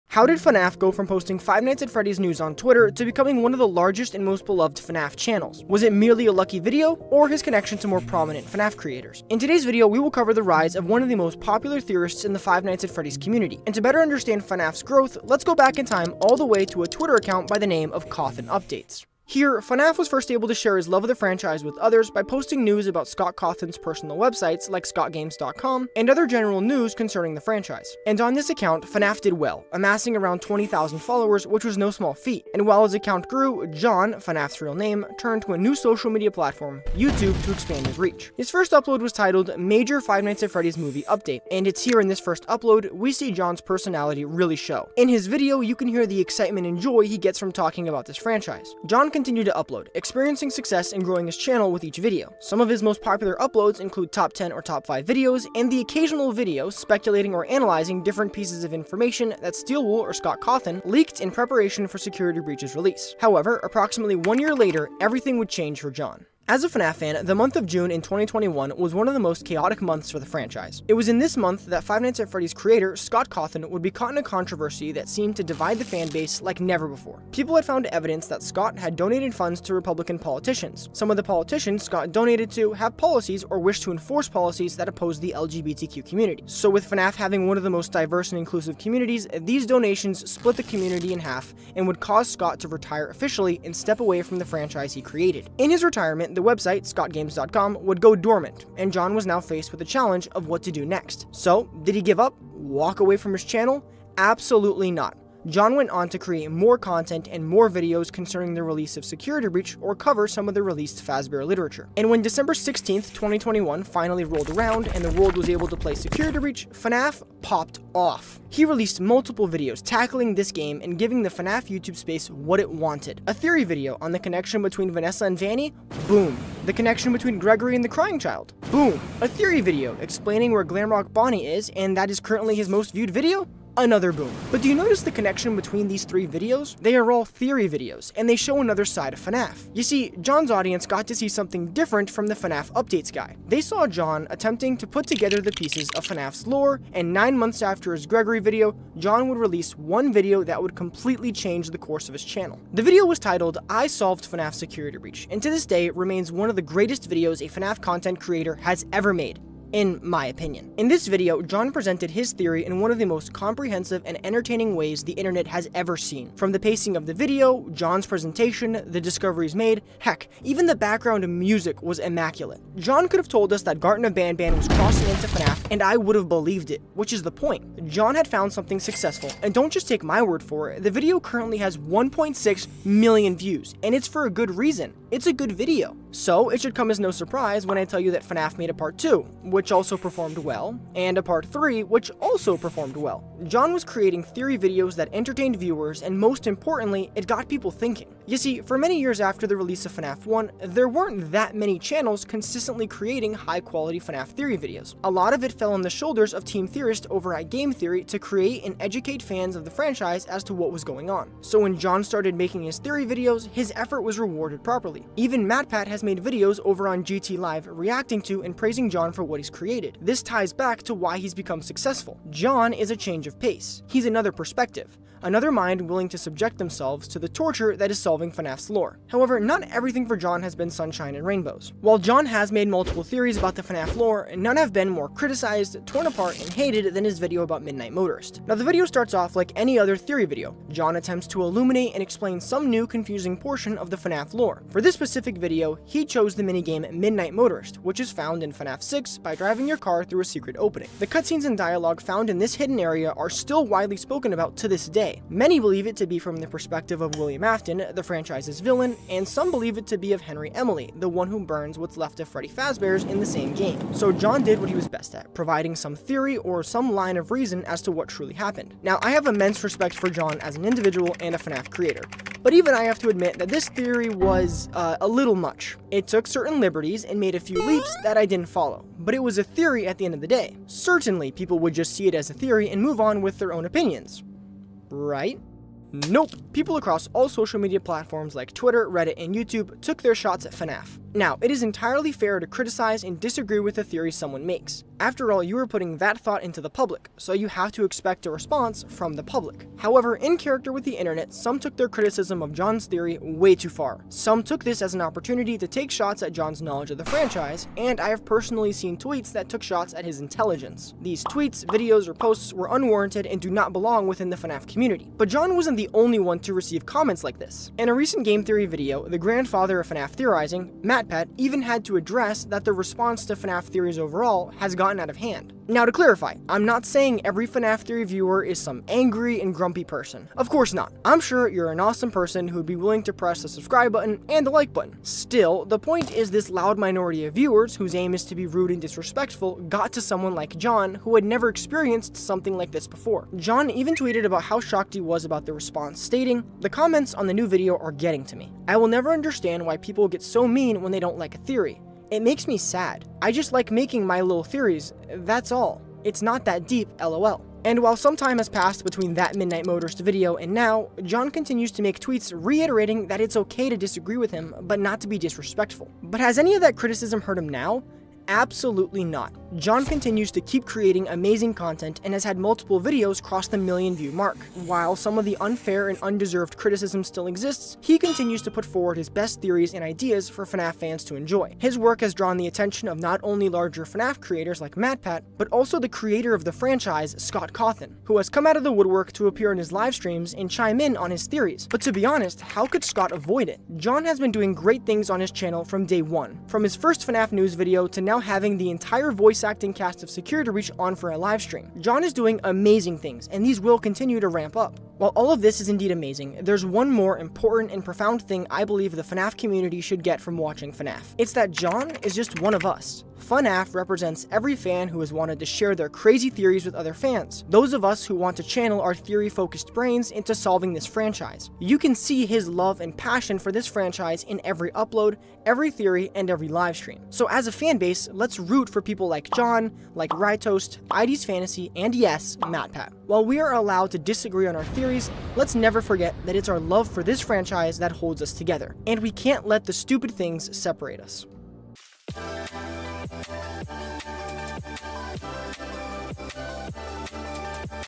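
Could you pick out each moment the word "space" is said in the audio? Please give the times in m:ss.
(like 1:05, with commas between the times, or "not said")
2:01.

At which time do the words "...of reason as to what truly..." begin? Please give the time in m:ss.
4:27.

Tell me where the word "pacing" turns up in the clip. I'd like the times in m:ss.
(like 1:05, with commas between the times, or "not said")
2:46.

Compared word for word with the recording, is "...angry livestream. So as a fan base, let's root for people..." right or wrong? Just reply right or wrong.
wrong.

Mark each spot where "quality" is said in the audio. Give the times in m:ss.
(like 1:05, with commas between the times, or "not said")
3:23.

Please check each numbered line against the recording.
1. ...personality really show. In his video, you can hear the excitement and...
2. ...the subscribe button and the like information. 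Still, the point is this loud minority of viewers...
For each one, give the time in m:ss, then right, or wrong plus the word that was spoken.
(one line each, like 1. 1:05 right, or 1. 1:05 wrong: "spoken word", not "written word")
1. 0:43 right
2. 5:33 wrong: "button", not "information".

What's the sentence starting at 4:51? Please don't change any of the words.
Now, it is entirely fair to criticize and disagree with the theory someone makes.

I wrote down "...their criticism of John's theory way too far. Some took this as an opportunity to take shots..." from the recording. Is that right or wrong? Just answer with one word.
right.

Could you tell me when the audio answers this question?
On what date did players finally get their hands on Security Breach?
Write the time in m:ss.
1:52.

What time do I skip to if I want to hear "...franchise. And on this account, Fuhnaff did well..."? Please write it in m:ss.
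0:27.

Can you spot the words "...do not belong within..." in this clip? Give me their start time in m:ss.
5:13.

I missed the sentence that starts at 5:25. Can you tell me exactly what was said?
Now to clarify, I'm not saying every FNAF 3 viewer is some angry and grumpy person.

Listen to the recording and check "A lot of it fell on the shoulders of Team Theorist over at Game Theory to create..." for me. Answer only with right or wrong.
right.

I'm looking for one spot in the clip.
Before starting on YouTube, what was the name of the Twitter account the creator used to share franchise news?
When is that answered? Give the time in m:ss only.
0:18.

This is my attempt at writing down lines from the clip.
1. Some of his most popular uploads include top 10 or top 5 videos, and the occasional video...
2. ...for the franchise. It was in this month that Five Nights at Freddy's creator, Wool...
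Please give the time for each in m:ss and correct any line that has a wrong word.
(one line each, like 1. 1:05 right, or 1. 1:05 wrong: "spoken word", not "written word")
1. 0:52 right
2. 1:10 wrong: "Scott", not "Wool".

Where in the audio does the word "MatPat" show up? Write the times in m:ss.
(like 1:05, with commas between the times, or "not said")
3:35, 5:20, 6:24, 7:12.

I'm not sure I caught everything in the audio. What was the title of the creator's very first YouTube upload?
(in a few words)
Major Five Nights at Freddy's Movie Update.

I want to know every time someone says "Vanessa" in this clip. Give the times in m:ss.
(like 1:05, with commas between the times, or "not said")
2:04.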